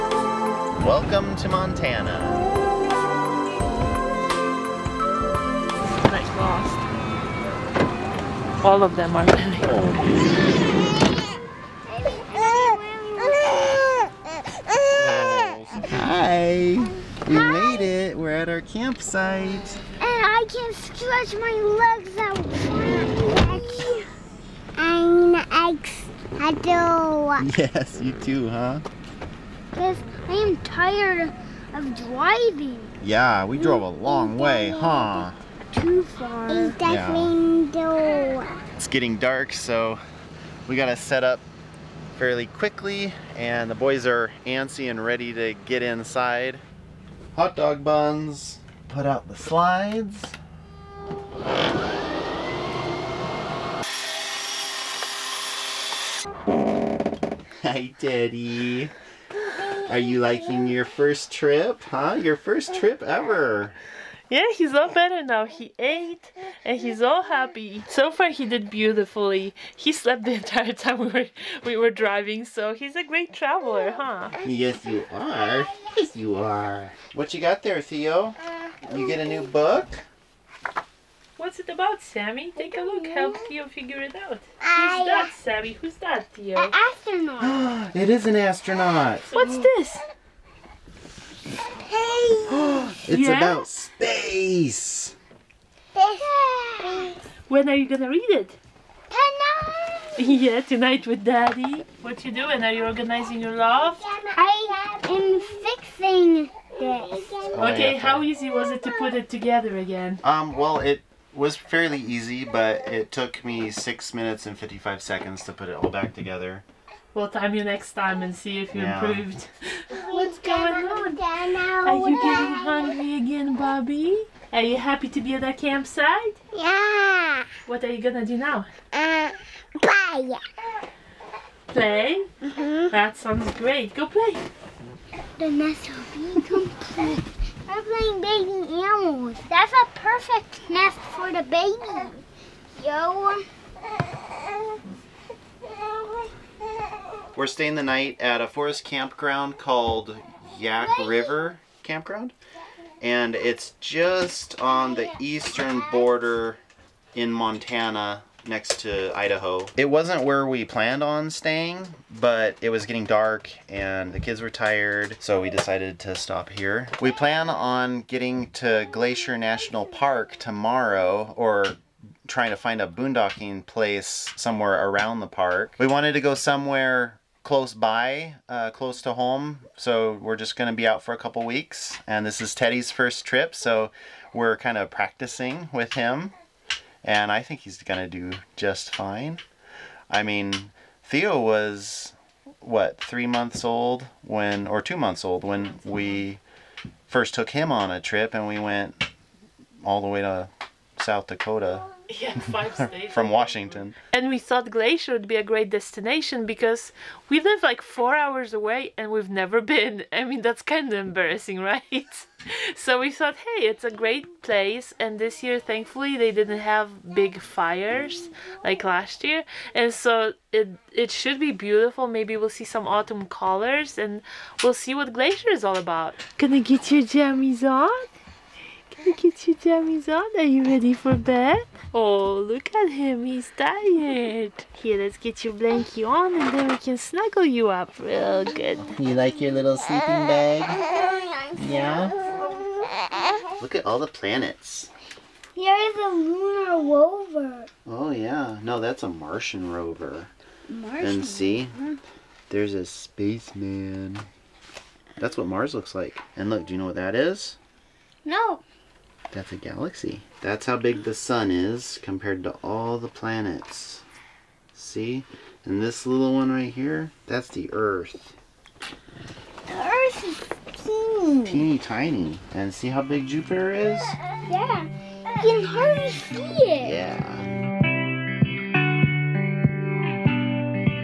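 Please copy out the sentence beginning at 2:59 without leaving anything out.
So we're just going to be out for a couple weeks.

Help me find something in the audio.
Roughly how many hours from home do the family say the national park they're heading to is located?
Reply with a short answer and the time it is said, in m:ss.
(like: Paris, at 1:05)
4, at 3:27.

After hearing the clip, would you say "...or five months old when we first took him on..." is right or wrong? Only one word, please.
wrong.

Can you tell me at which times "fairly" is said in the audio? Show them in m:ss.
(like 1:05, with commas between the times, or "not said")
0:42, 1:51.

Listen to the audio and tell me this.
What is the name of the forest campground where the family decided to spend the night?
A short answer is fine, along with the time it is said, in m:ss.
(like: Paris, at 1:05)
Yaak River Campground, at 2:30.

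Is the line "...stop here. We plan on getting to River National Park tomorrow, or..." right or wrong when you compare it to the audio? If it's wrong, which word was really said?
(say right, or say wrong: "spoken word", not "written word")
wrong: "Glacier", not "River".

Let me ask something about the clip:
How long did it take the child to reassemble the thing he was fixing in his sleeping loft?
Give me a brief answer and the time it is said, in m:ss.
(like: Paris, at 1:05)
6 minutes and 55 seconds, at 1:53.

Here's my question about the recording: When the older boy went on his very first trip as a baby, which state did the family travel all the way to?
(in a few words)
South Dakota.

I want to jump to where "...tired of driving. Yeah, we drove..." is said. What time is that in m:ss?
0:30.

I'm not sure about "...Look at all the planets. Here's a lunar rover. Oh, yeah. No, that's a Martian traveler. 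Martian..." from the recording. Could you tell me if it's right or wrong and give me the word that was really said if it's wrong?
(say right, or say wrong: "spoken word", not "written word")
wrong: "rover", not "traveler".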